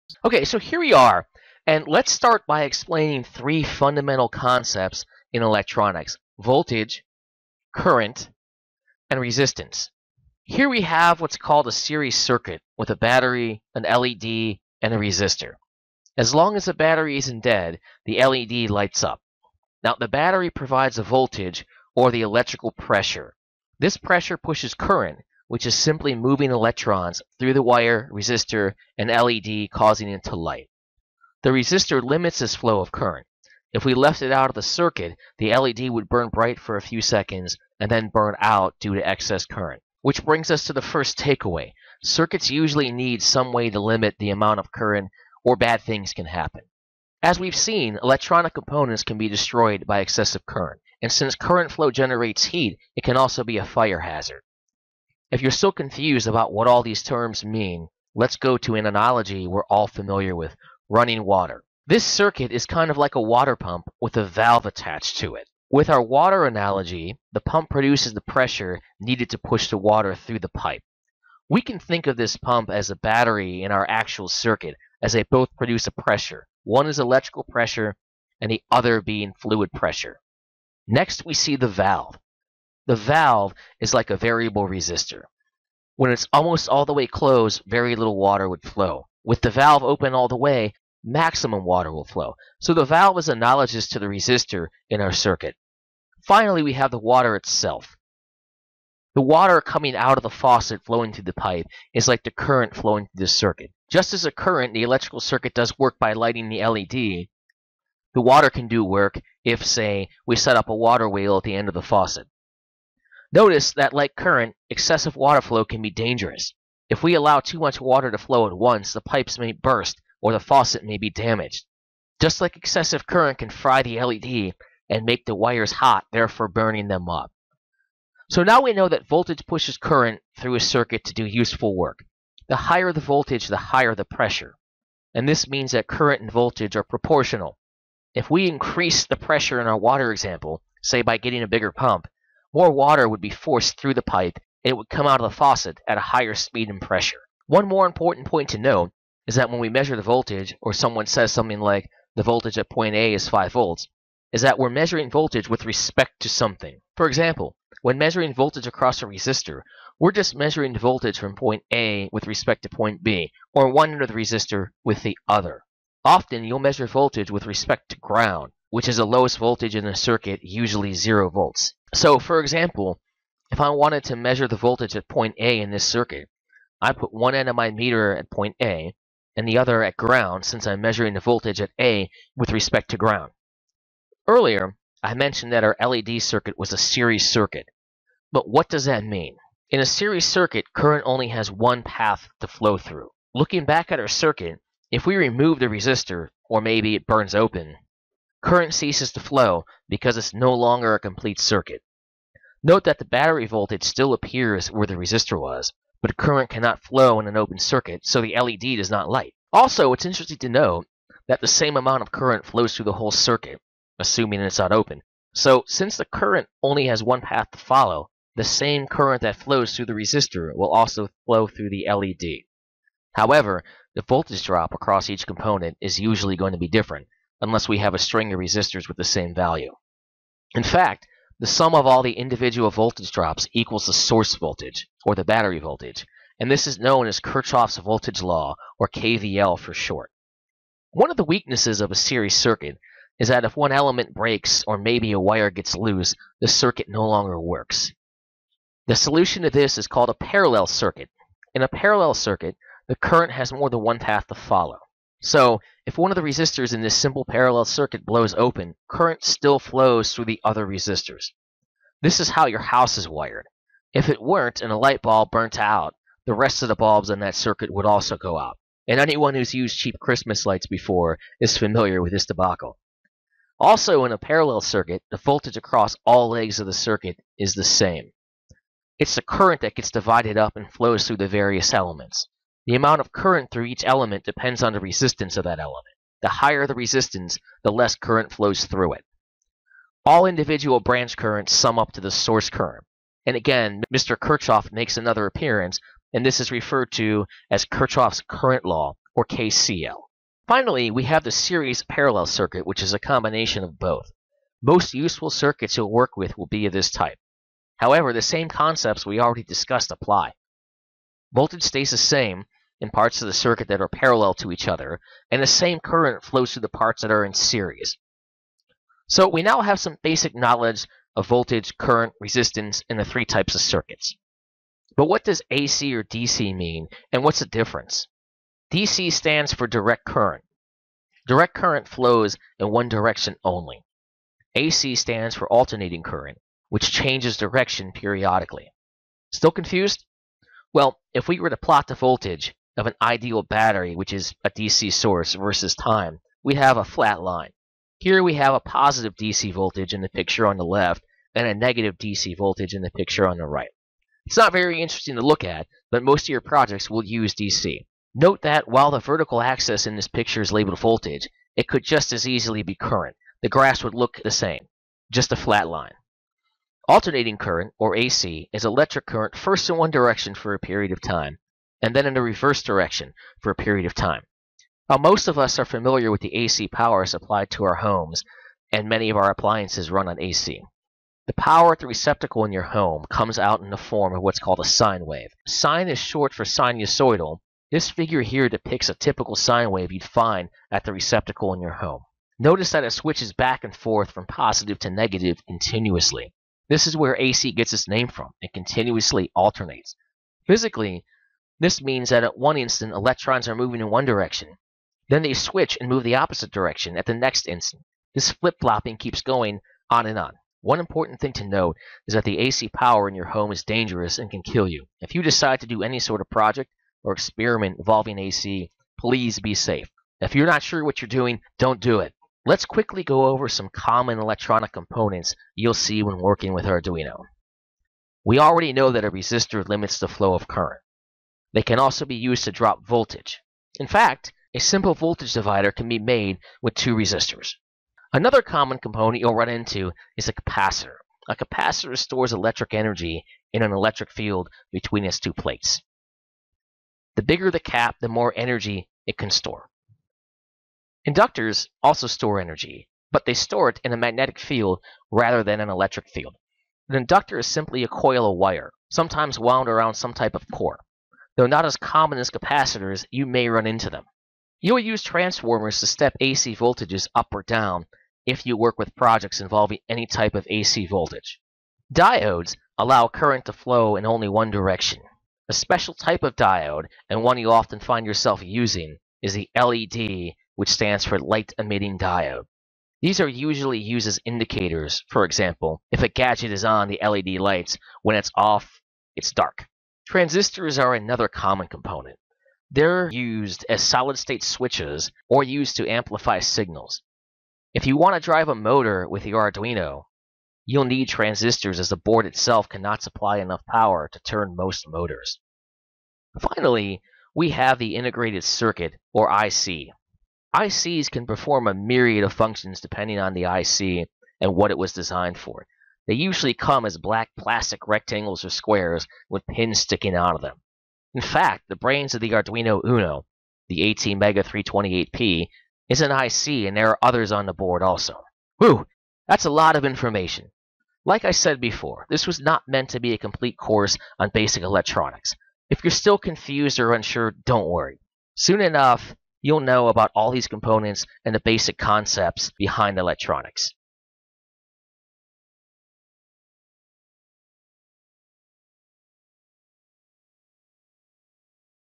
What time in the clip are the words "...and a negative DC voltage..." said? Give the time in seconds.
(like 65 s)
351 s.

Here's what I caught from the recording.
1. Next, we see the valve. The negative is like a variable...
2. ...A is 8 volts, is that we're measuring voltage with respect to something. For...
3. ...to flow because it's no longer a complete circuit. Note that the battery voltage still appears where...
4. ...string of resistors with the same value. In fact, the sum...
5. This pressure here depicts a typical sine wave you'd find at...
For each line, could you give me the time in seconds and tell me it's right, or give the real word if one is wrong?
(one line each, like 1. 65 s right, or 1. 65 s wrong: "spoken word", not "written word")
1. 80 s wrong: "valve", not "negative"
2. 152 s wrong: "5", not "8"
3. 199 s right
4. 227 s right
5. 387 s wrong: "figure", not "pressure".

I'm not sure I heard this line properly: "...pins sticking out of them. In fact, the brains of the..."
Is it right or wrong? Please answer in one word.
right.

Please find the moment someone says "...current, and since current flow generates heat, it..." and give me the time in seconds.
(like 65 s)
50 s.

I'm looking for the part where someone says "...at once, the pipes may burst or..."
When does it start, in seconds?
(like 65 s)
118 s.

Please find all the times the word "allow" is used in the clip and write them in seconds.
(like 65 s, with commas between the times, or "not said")
117 s, 472 s.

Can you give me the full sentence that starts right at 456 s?
An inductor is simply a coil of wire, sometimes wound around some type of core.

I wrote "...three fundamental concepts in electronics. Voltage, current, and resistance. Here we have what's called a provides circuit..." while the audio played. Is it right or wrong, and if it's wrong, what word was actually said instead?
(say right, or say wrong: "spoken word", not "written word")
wrong: "series", not "provides".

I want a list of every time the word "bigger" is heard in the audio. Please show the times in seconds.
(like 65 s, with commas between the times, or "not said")
141 s, 447 s.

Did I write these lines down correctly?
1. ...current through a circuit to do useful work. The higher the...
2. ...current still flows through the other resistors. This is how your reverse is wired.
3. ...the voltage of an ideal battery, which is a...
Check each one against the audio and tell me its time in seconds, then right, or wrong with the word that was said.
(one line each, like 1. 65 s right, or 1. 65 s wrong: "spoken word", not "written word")
1. 129 s right
2. 258 s wrong: "house", not "reverse"
3. 341 s right.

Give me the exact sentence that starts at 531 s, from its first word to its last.
Like I said before, this was not meant to be a complete course on basic electronics.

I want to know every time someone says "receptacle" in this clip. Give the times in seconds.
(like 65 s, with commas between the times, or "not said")
381 s, 390 s.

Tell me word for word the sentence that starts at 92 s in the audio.
So the valve is analogous to the resistor in our circuit.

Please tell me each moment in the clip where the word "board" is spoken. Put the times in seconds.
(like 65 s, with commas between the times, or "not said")
501 s, 527 s.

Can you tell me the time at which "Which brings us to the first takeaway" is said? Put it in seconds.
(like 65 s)
40 s.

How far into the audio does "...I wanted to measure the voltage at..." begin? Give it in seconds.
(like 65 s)
173 s.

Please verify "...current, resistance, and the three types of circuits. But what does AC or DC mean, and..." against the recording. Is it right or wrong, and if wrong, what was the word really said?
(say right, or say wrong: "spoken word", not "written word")
right.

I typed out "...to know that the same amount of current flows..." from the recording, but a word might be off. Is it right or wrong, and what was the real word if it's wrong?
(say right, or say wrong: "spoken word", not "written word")
right.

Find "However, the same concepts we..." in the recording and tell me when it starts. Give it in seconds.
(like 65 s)
307 s.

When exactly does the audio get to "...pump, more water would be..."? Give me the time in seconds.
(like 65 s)
141 s.